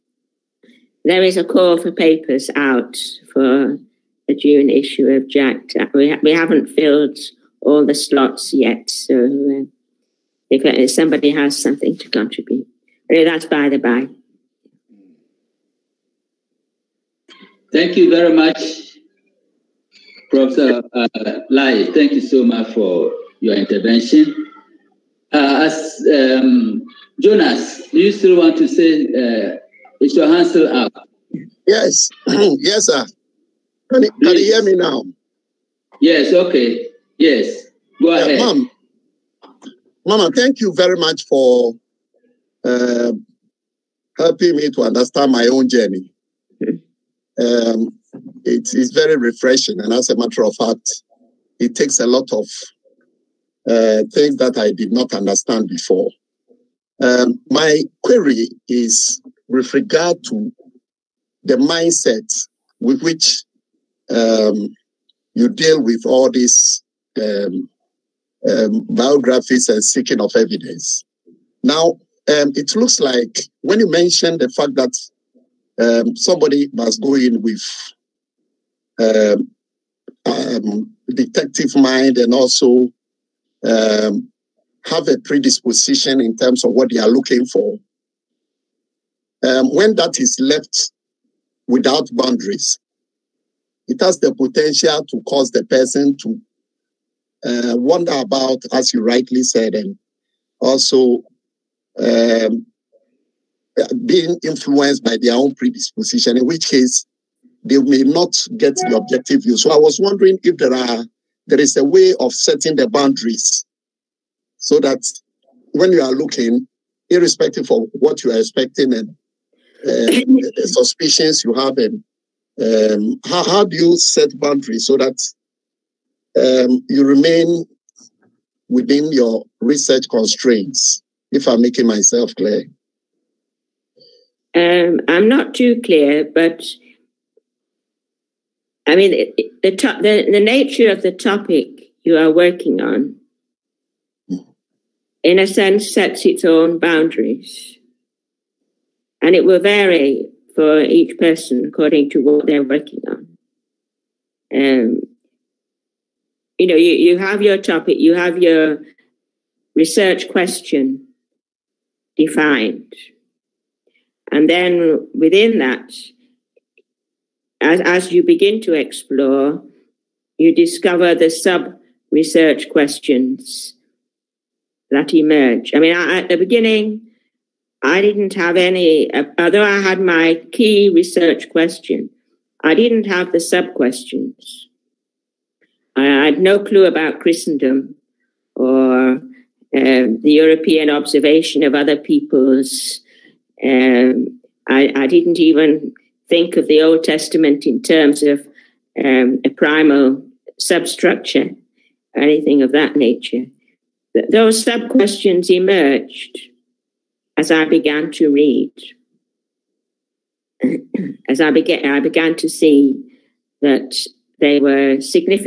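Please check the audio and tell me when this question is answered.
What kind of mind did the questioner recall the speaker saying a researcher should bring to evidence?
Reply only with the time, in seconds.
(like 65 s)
81 s.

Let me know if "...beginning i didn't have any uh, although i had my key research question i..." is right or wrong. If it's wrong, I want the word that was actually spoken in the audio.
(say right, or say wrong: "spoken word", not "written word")
right.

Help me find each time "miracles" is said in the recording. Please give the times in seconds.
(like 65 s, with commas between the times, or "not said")
not said.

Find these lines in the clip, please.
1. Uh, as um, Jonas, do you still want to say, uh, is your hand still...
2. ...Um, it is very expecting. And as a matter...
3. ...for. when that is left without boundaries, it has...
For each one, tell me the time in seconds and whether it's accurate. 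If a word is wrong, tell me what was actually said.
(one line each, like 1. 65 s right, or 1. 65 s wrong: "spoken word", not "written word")
1. 25 s right
2. 47 s wrong: "refreshing", not "expecting"
3. 87 s right.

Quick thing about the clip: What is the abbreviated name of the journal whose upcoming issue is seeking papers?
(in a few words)
JACT.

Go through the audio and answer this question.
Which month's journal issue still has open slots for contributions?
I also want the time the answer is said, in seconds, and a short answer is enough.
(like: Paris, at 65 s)
June, at 4 s.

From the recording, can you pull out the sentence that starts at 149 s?
And it will vary for each person according to what they're working on.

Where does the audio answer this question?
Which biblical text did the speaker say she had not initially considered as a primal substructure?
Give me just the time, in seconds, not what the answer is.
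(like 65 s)
196 s.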